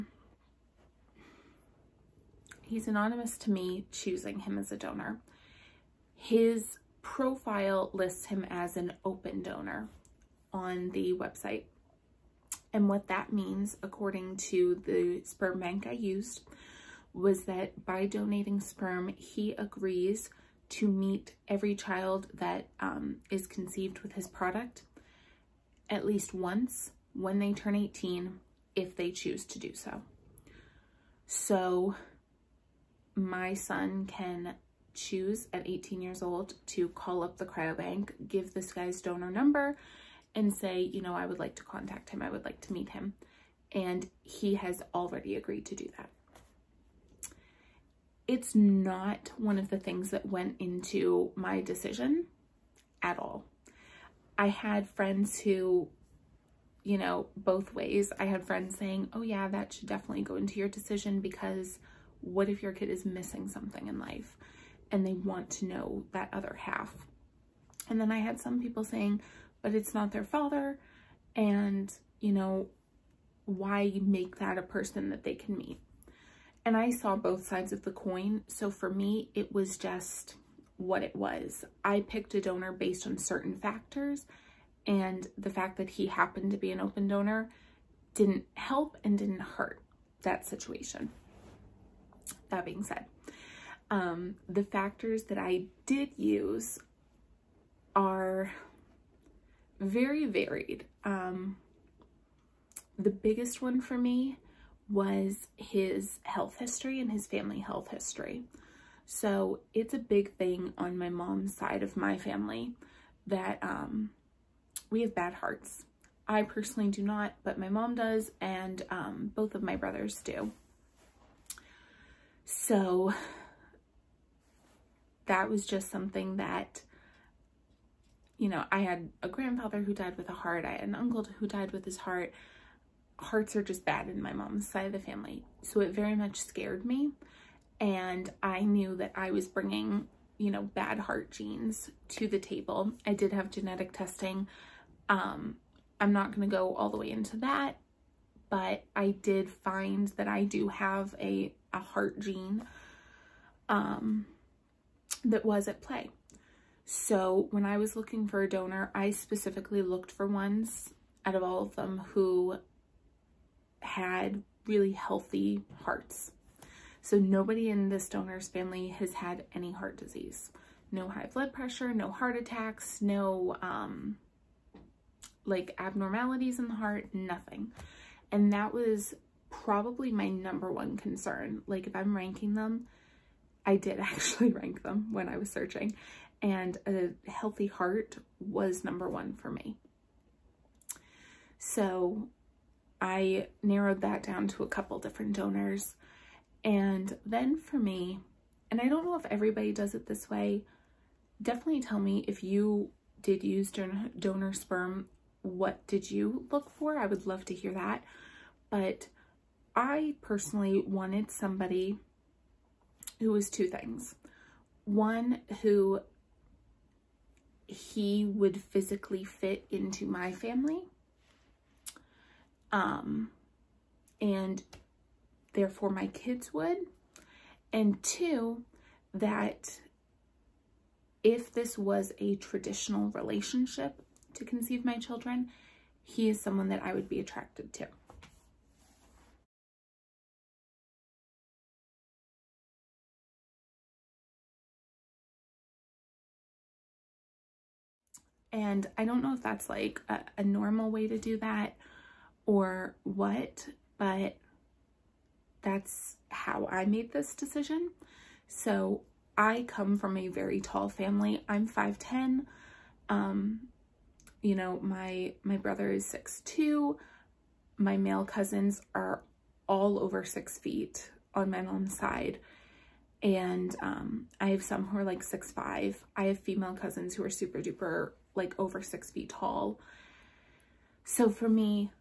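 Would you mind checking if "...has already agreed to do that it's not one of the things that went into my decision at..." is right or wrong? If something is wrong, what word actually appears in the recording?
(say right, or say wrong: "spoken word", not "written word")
right.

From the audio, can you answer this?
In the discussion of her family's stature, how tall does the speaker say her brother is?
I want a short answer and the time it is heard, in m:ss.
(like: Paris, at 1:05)
6'2", at 4:26.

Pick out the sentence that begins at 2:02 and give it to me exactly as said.
So that was just something that, you know, I had a grandfather who died with a heart.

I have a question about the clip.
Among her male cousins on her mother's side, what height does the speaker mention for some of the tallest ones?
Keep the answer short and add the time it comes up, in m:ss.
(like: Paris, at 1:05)
6'5", at 4:35.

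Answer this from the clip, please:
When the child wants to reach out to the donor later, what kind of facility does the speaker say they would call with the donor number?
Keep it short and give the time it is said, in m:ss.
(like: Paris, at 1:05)
cryobank, at 0:37.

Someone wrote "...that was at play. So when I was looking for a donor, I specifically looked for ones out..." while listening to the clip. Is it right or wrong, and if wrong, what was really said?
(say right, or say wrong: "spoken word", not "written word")
right.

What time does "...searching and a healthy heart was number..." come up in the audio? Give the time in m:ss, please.
3:05.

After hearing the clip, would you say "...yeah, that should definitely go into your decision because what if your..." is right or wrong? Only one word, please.
right.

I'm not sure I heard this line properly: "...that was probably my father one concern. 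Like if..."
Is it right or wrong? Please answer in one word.
wrong.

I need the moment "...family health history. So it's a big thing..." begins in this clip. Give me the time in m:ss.
1:47.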